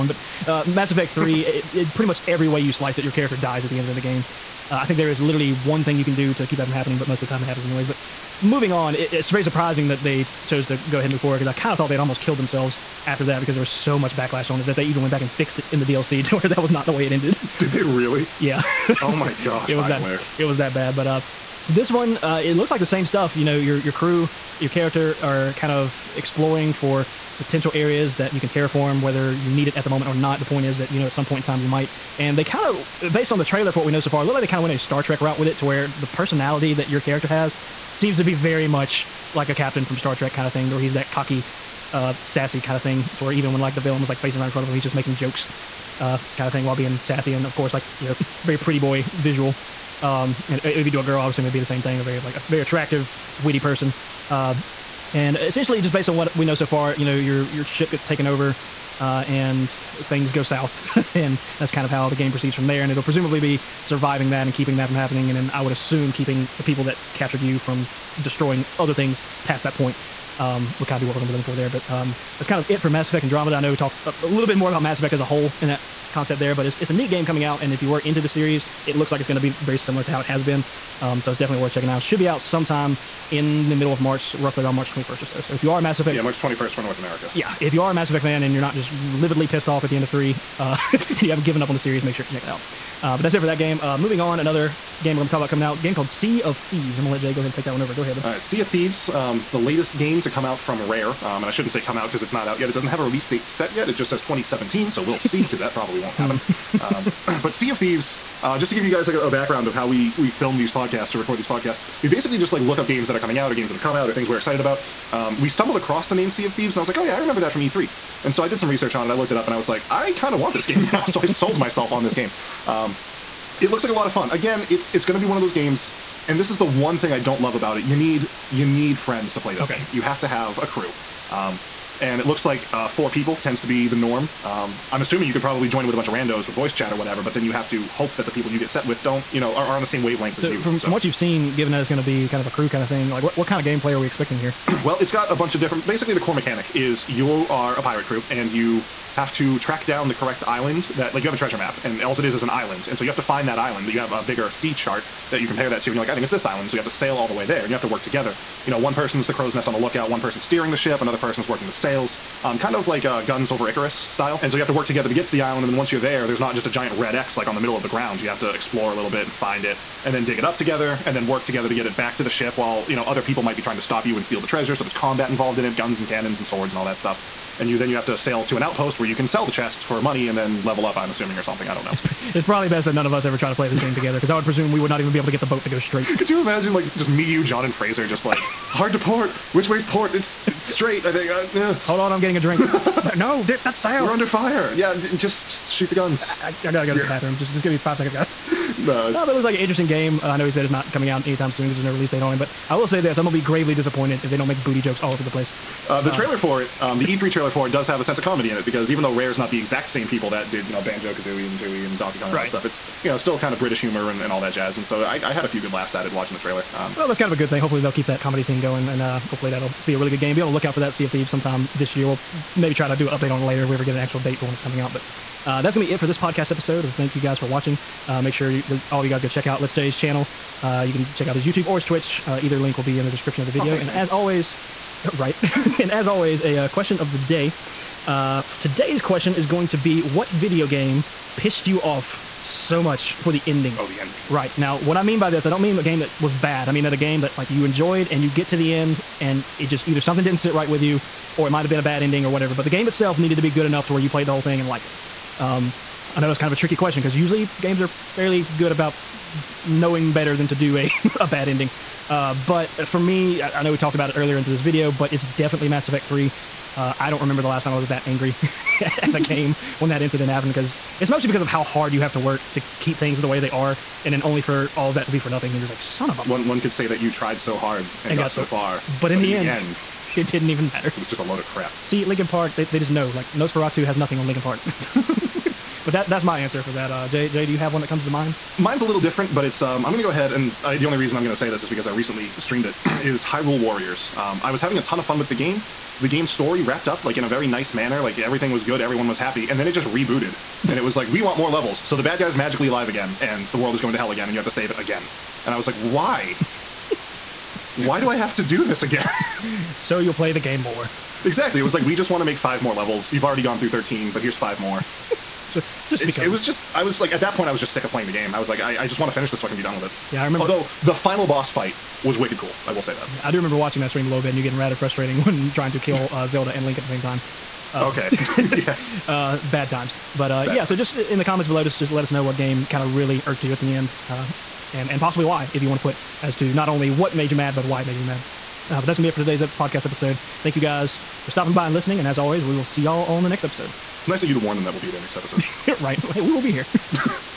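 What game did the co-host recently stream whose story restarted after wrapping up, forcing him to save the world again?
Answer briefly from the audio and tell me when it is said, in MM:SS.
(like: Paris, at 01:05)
Hyrule Warriors, at 04:53.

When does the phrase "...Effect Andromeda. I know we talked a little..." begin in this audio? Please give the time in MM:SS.
01:13.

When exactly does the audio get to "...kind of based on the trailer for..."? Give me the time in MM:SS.
00:32.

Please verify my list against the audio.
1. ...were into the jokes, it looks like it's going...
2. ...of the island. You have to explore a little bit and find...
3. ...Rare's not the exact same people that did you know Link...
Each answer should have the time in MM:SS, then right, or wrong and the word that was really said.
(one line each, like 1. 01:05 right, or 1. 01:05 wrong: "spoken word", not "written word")
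1. 01:17 wrong: "series", not "jokes"
2. 02:47 wrong: "ground", not "island"
3. 03:29 wrong: "Banjo", not "Link".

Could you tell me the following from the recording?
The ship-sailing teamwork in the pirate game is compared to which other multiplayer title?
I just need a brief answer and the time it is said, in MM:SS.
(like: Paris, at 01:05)
Guns of Icarus, at 02:43.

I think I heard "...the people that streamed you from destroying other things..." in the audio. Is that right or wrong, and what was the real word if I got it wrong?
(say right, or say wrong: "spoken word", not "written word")
wrong: "captured", not "streamed".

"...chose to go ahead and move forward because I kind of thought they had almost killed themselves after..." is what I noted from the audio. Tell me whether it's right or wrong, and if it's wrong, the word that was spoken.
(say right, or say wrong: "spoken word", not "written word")
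right.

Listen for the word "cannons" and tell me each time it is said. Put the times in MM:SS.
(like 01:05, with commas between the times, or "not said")
02:56.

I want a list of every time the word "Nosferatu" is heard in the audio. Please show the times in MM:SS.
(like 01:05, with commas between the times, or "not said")
04:43.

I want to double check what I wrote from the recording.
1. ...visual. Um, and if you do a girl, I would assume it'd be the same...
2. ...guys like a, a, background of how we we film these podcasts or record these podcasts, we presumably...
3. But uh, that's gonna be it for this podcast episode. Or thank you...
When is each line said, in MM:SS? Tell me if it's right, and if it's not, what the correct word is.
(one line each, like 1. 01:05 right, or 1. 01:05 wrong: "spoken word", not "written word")
1. 00:49 right
2. 01:48 wrong: "basically", not "presumably"
3. 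03:44 right.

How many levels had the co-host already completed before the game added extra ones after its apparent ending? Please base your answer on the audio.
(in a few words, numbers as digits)
13.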